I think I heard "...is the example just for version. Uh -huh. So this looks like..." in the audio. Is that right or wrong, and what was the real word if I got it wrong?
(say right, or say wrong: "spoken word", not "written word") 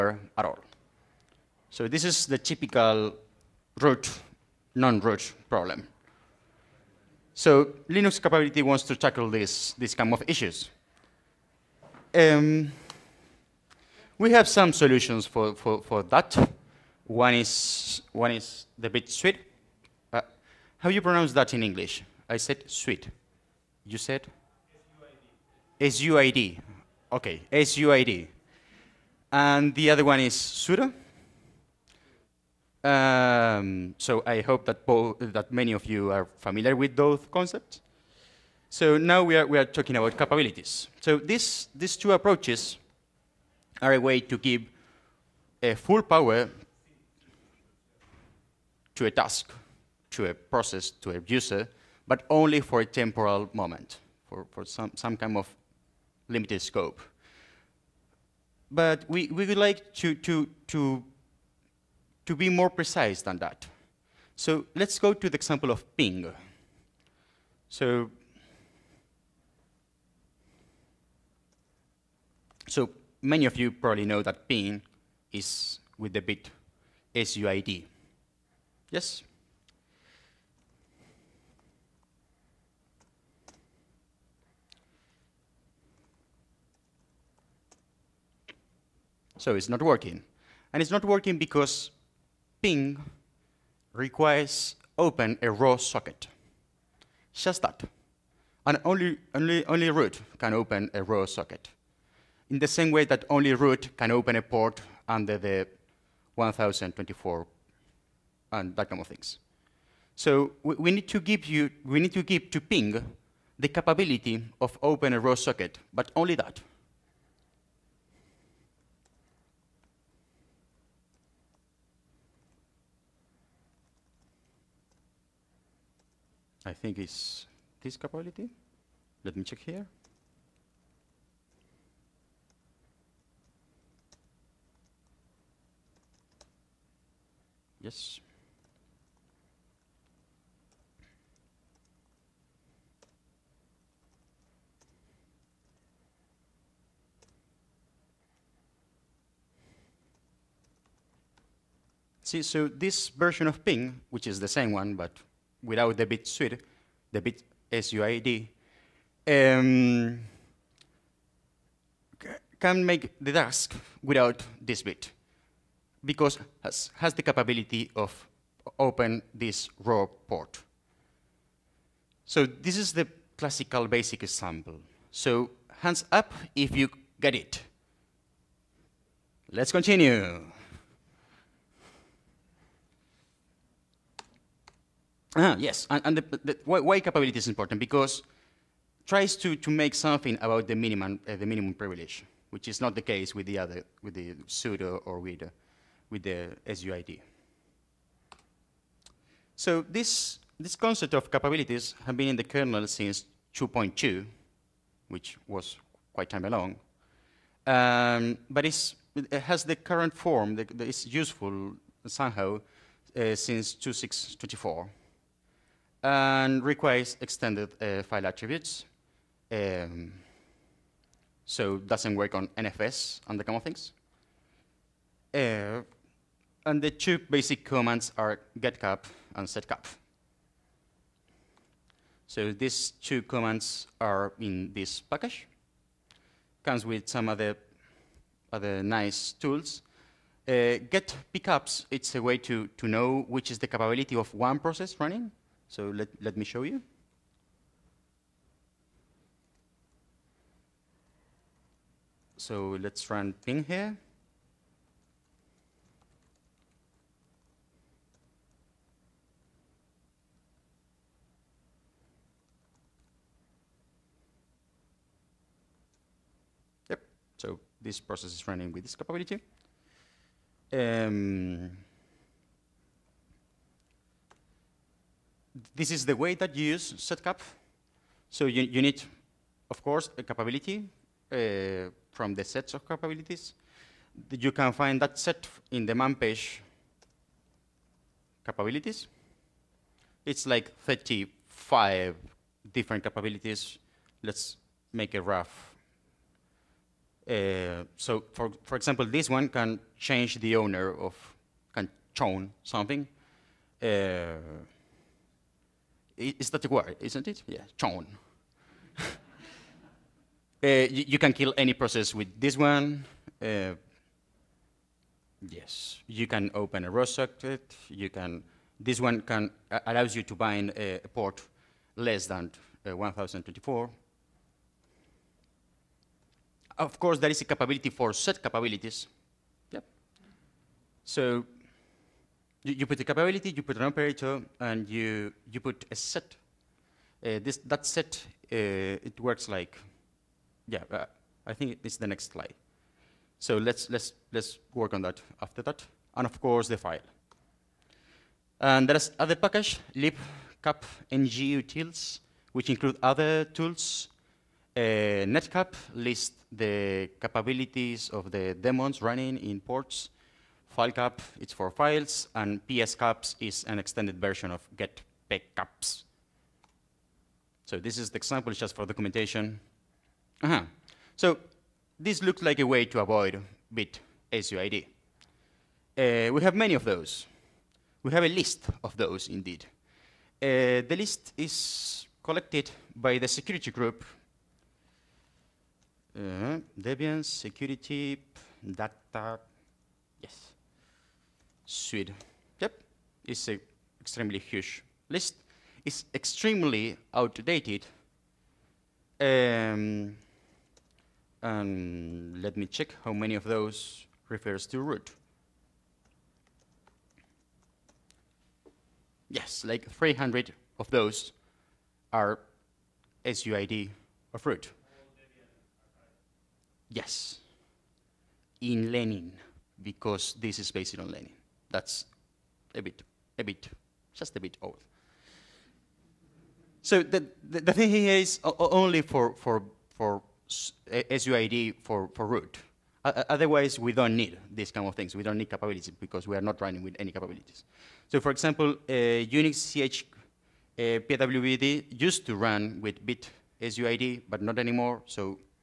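wrong: "documentation", not "version".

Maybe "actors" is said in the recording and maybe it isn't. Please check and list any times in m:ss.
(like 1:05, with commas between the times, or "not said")
not said.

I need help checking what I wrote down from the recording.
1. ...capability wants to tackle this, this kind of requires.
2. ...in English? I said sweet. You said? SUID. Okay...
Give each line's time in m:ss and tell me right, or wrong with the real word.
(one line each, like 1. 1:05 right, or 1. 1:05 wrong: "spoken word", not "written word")
1. 0:08 wrong: "issues", not "requires"
2. 0:21 right.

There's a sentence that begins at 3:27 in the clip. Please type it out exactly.
Um, but it has the current form that, that is useful somehow uh, since 2.6.24 and requires extended uh, file attributes.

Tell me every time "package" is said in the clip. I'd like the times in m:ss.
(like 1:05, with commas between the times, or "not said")
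3:55, 5:49.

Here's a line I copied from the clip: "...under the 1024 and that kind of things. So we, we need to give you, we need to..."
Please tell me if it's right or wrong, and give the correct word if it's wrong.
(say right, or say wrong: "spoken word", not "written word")
right.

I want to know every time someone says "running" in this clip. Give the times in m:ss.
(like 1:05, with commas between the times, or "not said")
4:04, 4:28, 5:59, 7:16.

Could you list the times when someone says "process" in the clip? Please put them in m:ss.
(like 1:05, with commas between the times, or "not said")
0:50, 4:04, 4:28, 5:11.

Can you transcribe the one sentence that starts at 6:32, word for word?
Yep, it's an extremely huge list.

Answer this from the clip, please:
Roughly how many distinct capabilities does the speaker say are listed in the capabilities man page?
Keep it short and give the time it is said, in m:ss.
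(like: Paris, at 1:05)
35, at 4:50.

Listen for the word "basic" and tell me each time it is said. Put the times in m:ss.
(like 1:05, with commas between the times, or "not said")
2:53, 3:47.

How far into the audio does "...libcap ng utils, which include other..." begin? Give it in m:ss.
5:49.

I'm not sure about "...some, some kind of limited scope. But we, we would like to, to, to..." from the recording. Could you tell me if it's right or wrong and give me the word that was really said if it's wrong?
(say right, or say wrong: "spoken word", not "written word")
right.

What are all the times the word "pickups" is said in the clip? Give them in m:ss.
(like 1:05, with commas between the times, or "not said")
4:01.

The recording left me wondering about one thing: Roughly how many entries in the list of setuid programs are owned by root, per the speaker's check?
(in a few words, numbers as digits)
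300.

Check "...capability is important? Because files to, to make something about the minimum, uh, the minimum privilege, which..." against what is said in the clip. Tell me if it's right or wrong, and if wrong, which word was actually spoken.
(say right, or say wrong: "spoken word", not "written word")
wrong: "tries", not "files".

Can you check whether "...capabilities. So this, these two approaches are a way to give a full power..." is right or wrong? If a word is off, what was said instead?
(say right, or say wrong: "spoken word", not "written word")
right.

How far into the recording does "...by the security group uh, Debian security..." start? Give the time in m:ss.
6:22.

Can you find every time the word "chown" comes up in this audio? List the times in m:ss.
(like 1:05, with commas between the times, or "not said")
5:02, 5:07.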